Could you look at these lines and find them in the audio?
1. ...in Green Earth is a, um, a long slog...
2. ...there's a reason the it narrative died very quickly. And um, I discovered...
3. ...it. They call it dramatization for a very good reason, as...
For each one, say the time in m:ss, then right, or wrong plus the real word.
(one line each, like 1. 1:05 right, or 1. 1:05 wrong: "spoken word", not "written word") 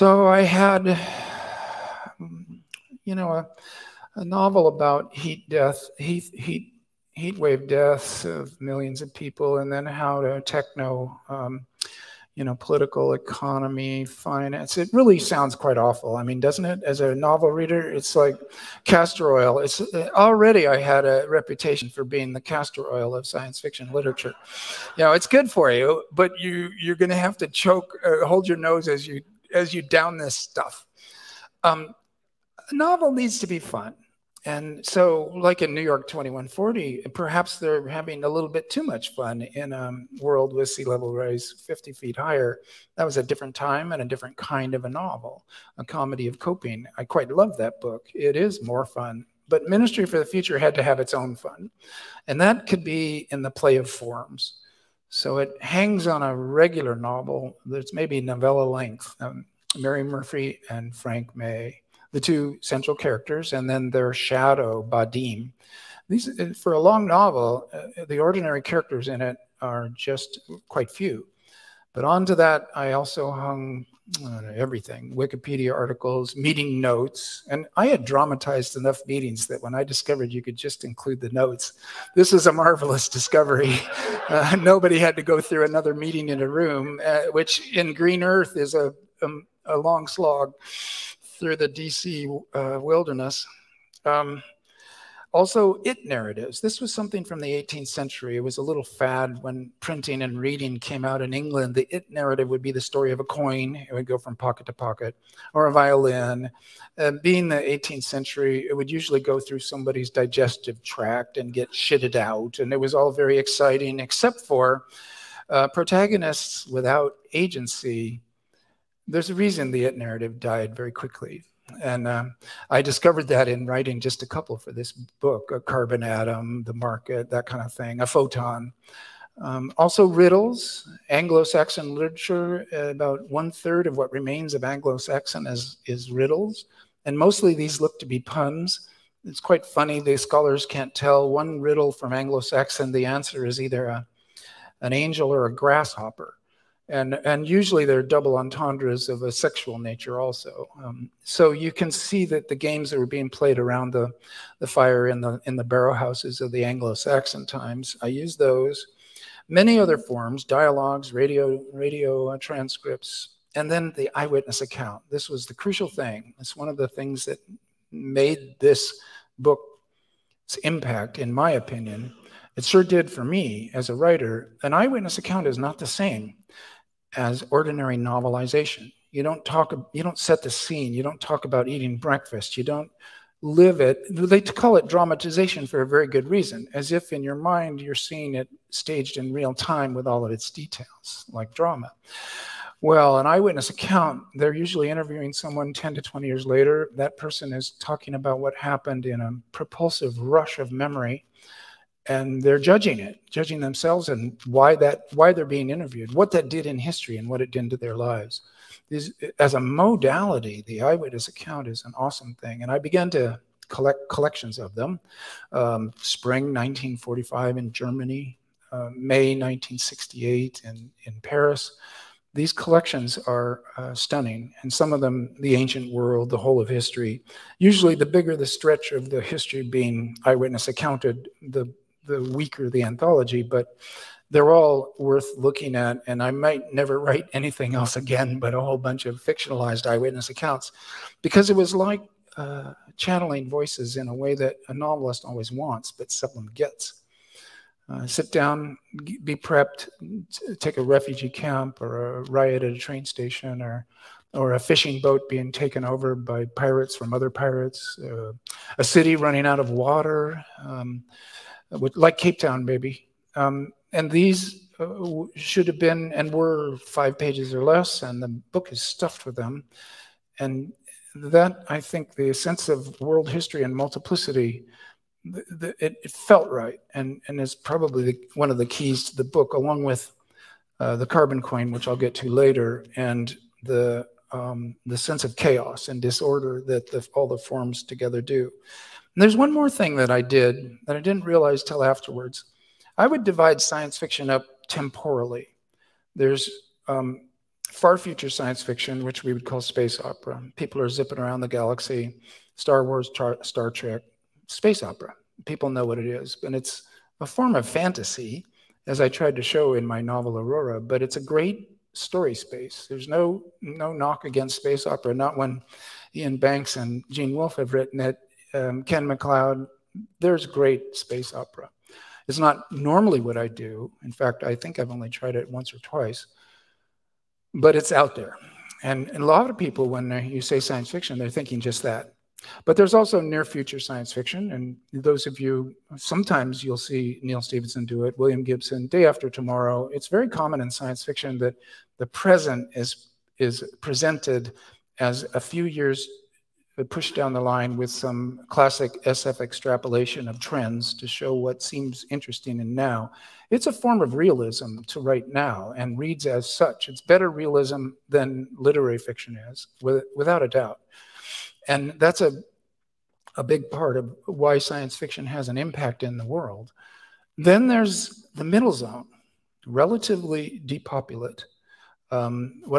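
1. 1:27 right
2. 1:59 right
3. 3:03 right.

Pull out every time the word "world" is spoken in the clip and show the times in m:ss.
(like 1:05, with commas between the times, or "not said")
0:40, 3:45, 4:33, 6:06.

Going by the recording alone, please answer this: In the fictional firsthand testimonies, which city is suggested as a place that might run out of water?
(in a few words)
Cape Town.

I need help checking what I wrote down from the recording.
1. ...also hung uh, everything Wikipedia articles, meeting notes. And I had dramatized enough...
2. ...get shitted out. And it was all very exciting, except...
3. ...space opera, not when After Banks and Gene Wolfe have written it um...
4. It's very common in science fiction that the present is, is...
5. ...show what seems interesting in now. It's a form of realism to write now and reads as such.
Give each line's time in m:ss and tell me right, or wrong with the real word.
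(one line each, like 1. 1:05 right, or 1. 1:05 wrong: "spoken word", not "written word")
1. 1:12 right
2. 1:51 right
3. 5:14 wrong: "Iain", not "After"
4. 5:39 right
5. 5:51 right.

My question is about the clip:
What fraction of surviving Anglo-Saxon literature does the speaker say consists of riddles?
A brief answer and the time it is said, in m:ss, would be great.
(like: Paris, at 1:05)
one third, at 2:13.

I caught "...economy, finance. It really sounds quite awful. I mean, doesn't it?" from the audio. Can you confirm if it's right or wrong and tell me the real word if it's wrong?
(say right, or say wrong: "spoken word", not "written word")
right.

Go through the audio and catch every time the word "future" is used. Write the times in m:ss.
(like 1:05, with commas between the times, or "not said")
0:50, 4:57, 5:33.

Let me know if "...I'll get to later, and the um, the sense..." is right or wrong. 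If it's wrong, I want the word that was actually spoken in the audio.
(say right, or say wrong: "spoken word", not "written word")
right.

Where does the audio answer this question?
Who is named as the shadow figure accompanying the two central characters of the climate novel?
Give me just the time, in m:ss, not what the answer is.
1:04.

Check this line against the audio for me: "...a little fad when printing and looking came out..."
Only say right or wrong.
wrong.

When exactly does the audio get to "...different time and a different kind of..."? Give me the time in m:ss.
0:43.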